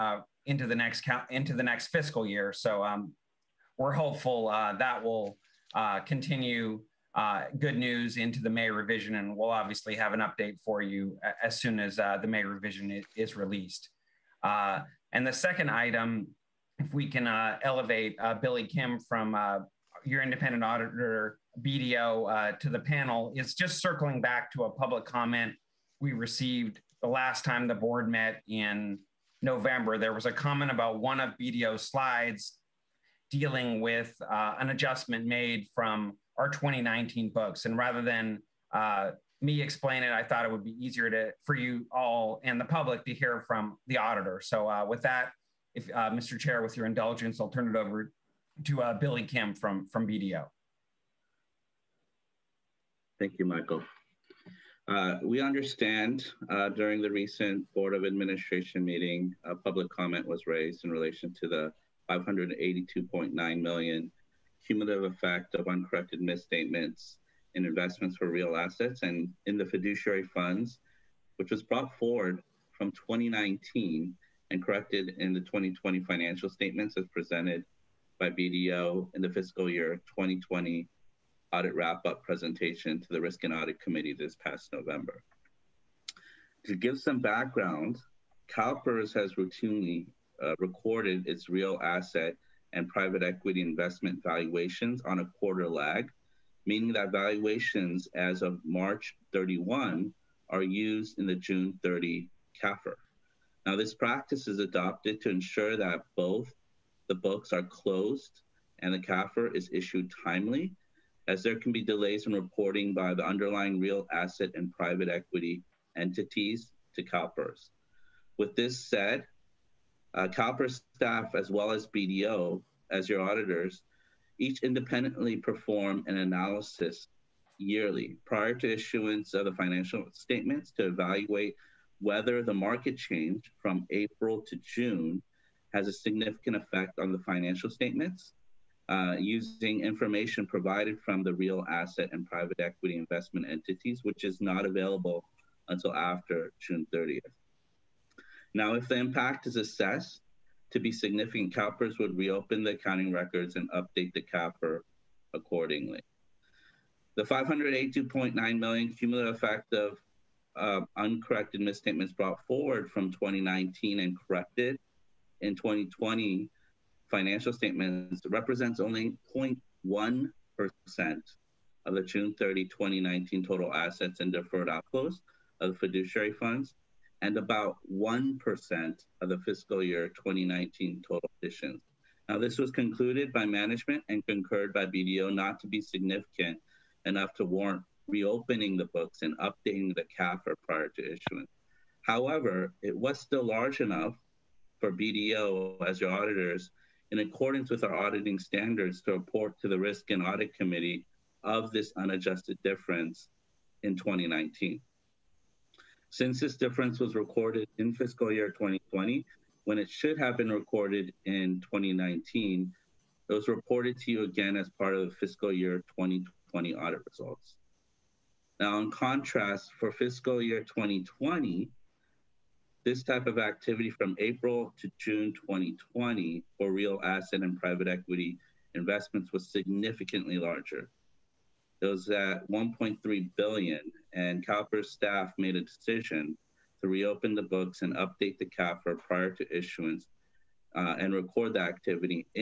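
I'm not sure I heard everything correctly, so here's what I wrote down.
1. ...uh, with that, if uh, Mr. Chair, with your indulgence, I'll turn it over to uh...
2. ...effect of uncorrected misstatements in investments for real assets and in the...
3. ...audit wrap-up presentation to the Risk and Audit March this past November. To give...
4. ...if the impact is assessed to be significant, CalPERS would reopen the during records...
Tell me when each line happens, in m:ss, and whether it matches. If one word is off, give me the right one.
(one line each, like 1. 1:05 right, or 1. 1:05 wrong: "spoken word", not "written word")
1. 0:44 right
2. 1:05 right
3. 1:21 wrong: "Committee", not "March"
4. 2:28 wrong: "accounting", not "during".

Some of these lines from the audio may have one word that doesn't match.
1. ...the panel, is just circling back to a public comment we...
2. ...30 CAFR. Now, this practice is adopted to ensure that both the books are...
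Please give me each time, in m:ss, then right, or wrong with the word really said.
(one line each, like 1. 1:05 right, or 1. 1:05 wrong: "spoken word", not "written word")
1. 0:22 right
2. 1:41 right.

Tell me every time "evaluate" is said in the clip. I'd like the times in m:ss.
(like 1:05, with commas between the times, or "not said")
2:10.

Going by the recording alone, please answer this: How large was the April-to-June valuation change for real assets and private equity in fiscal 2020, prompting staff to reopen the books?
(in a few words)
$1.3 billion.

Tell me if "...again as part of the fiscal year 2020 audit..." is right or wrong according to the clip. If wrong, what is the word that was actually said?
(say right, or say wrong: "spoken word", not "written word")
right.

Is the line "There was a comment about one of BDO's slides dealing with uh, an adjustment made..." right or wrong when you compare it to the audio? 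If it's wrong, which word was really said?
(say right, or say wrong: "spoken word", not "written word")
right.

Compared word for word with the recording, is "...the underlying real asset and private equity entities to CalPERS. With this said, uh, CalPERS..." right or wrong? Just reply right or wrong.
right.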